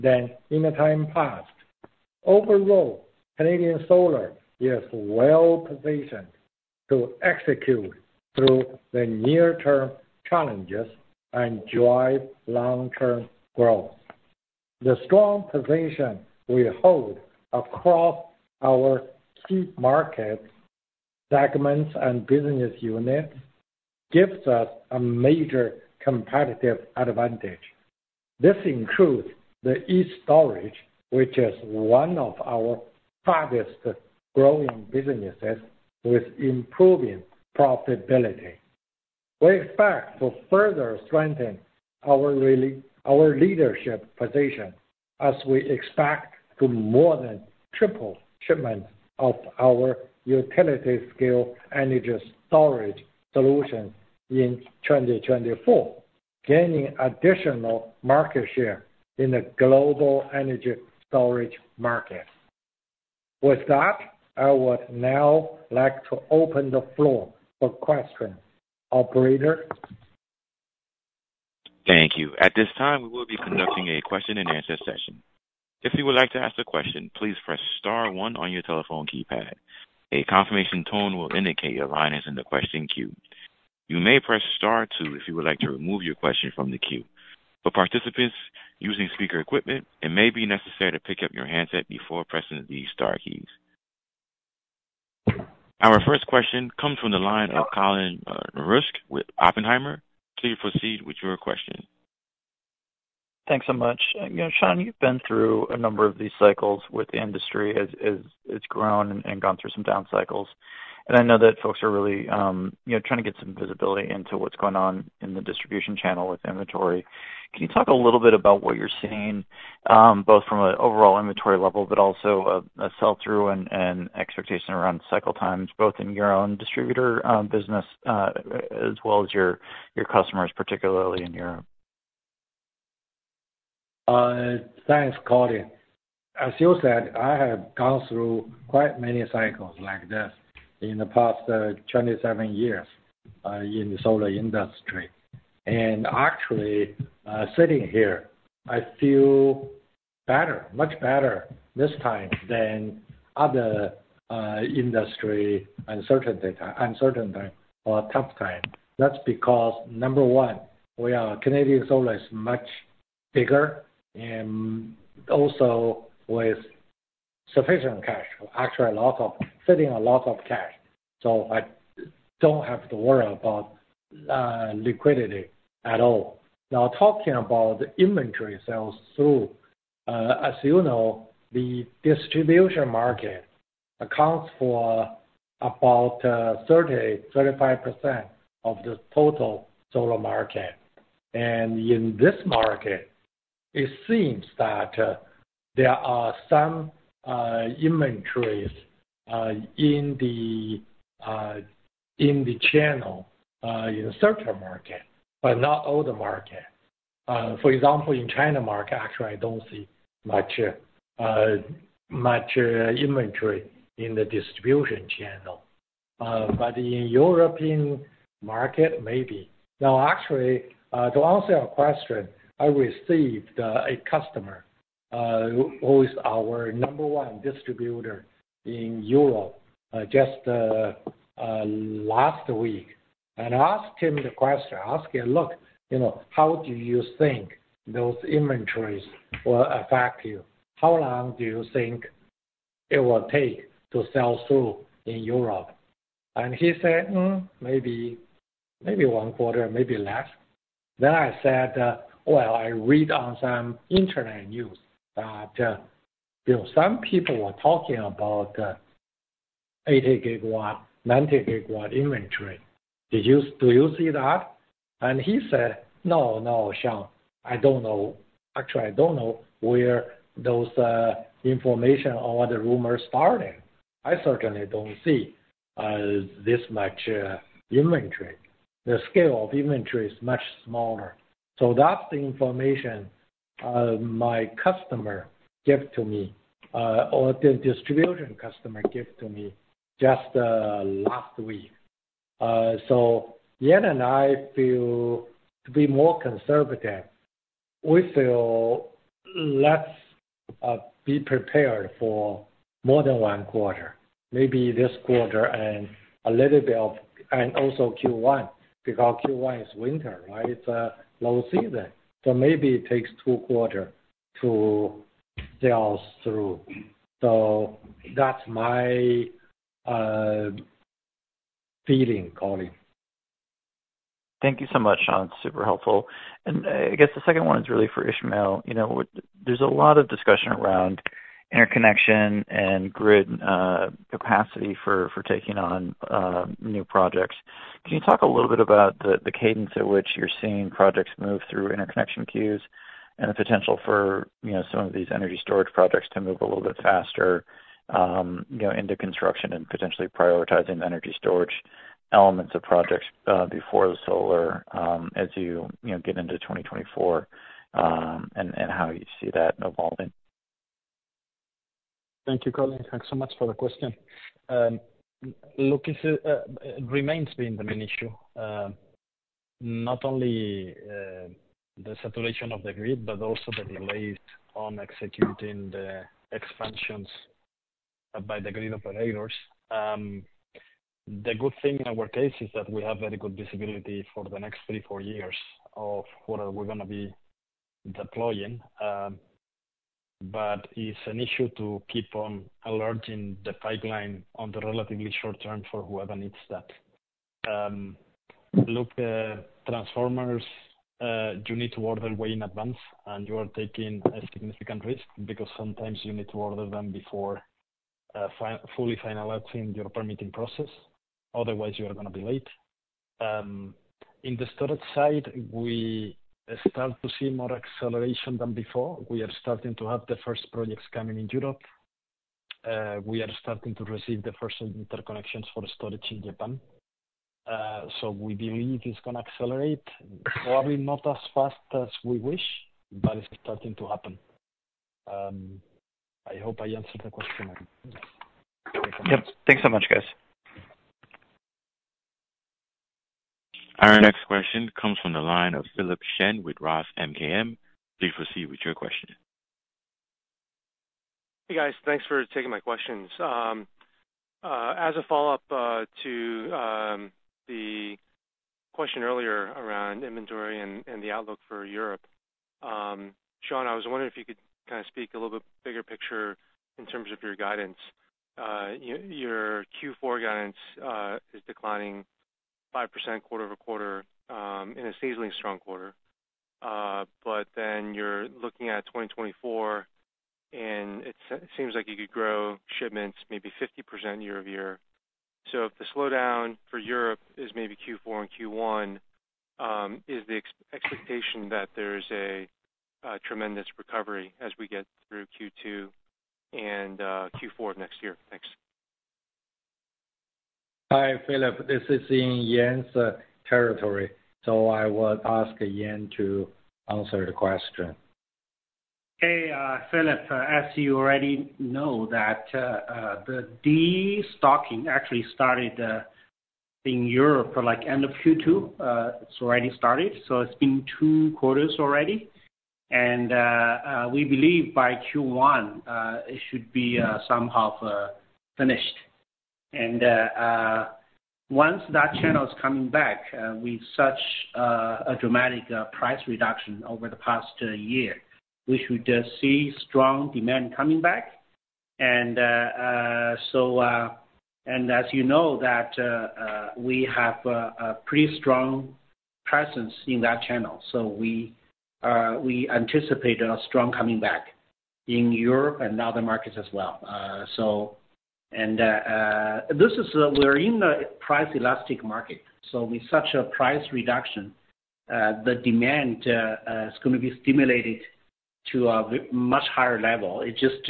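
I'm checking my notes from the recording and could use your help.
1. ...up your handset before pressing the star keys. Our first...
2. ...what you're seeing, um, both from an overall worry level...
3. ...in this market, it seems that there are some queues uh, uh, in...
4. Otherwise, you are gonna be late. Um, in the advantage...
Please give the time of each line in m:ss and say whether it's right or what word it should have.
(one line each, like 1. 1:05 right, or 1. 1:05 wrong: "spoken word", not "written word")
1. 1:31 right
2. 1:58 wrong: "inventory", not "worry"
3. 3:11 wrong: "inventories", not "queues"
4. 6:51 wrong: "storage", not "advantage".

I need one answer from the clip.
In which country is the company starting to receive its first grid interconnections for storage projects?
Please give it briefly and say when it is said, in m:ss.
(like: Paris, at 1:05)
Japan, at 7:06.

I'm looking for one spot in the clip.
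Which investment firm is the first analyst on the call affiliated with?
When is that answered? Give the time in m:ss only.
1:39.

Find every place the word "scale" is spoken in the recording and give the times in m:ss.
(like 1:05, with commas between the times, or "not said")
0:50, 4:39.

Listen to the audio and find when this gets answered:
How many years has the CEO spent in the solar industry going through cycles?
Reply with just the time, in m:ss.
2:21.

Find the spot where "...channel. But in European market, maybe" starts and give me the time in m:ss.
3:35.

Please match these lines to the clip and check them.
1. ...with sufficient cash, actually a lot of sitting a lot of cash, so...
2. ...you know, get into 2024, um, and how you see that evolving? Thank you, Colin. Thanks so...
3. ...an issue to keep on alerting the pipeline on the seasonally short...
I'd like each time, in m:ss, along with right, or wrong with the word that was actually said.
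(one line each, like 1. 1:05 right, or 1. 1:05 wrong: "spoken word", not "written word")
1. 2:46 right
2. 5:55 right
3. 6:31 wrong: "relatively", not "seasonally".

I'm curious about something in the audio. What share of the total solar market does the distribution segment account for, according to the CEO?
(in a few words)
30%-35%.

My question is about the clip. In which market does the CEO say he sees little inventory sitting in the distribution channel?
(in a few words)
China.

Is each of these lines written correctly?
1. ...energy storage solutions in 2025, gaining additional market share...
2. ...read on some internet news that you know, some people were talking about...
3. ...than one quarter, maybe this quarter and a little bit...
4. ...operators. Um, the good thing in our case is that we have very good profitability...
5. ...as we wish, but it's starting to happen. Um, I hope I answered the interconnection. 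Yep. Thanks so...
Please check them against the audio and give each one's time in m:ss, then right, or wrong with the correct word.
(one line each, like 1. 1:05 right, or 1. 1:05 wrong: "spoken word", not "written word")
1. 0:51 wrong: "2024", not "2025"
2. 4:12 right
3. 5:03 right
4. 6:18 wrong: "visibility", not "profitability"
5. 7:11 wrong: "question", not "interconnection".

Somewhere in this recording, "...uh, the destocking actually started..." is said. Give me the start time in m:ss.
8:32.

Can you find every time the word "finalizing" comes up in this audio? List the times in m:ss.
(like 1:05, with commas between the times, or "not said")
6:49.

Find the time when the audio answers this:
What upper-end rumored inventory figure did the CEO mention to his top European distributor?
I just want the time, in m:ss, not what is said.
4:21.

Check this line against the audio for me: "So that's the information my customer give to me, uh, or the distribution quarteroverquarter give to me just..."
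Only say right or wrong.
wrong.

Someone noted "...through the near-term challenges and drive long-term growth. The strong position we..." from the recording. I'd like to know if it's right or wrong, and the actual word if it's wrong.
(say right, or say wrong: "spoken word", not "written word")
right.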